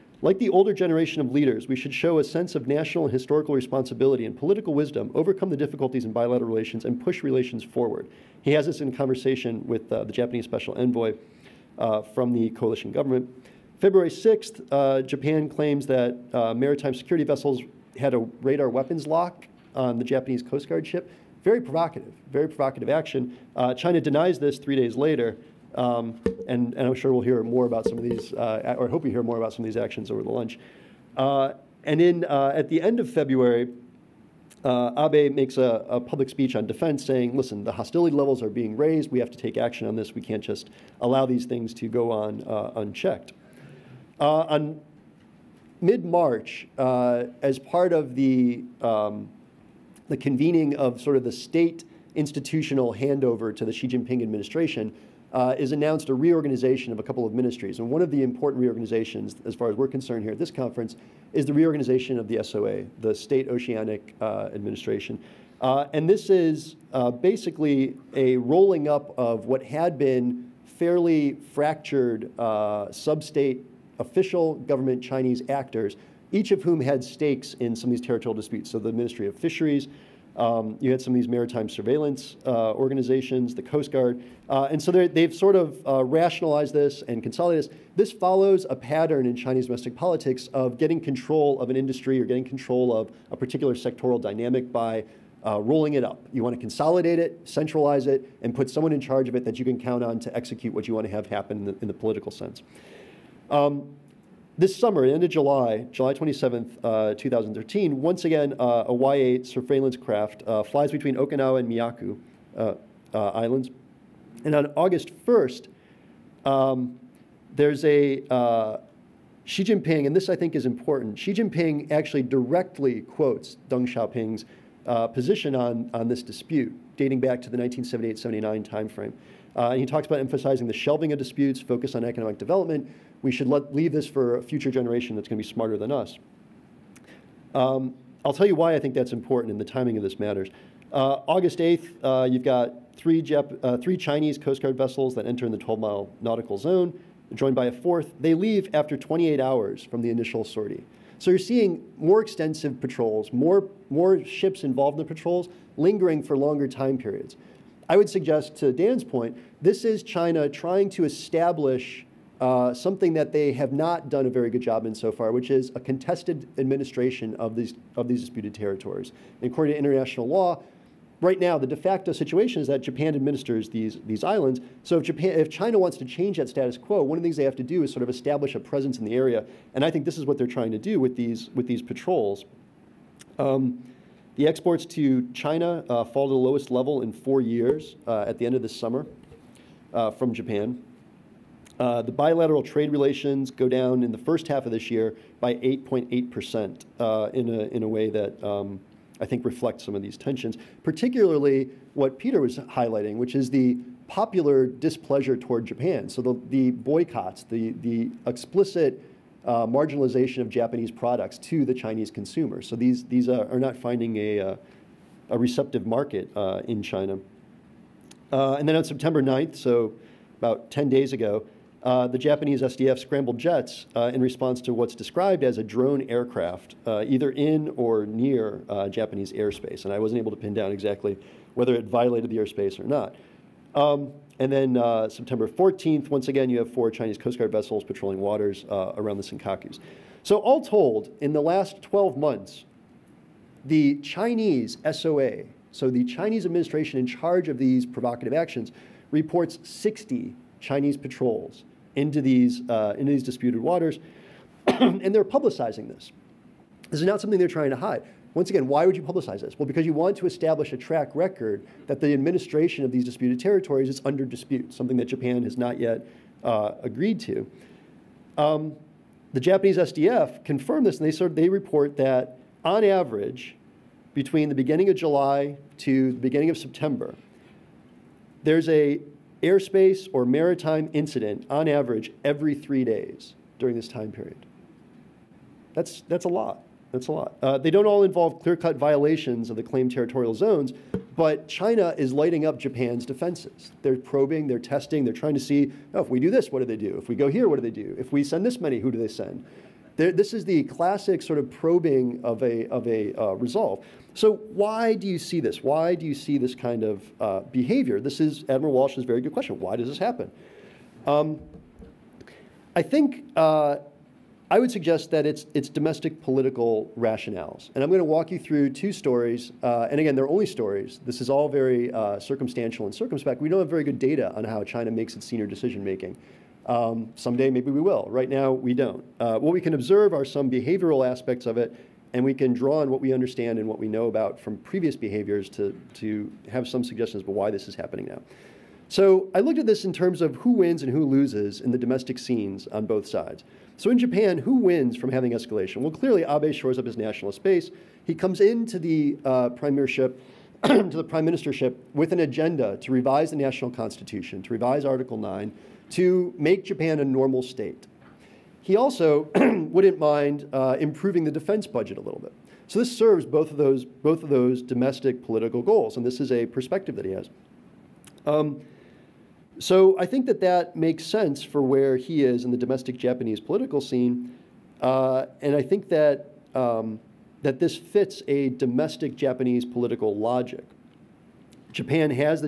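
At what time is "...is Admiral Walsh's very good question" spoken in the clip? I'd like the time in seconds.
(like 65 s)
308 s.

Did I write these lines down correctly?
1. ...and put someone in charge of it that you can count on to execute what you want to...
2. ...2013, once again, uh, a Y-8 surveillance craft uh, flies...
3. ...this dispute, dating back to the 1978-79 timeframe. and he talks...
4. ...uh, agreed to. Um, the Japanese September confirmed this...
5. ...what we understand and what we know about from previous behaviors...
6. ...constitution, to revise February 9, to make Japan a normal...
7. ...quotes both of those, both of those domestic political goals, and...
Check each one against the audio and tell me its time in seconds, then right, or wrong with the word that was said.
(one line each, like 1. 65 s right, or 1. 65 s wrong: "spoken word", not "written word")
1. 98 s right
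2. 107 s right
3. 126 s right
4. 266 s wrong: "SDF", not "September"
5. 332 s right
6. 353 s wrong: "Article", not "February"
7. 362 s wrong: "serves", not "quotes".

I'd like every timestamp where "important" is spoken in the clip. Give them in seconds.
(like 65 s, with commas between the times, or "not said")
58 s, 120 s, 139 s.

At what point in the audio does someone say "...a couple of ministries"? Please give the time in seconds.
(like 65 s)
56 s.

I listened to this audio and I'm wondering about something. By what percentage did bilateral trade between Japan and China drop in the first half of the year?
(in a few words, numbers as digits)
8.8 percent.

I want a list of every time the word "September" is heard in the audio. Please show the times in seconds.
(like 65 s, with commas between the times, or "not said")
218 s, 235 s, 276 s.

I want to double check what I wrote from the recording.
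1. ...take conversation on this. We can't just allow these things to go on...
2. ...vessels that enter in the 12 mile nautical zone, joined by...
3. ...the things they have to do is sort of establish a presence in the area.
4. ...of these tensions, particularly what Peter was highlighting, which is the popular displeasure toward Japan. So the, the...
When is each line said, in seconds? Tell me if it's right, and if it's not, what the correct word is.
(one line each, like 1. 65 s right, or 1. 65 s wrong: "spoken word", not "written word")
1. 39 s wrong: "action", not "conversation"
2. 144 s right
3. 177 s right
4. 199 s right.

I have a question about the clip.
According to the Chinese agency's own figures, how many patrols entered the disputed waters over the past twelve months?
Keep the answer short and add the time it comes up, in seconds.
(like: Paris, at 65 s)
60, at 249 s.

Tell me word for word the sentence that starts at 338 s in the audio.
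So I looked at this in terms of who wins and who loses in the domestic scenes on both sides.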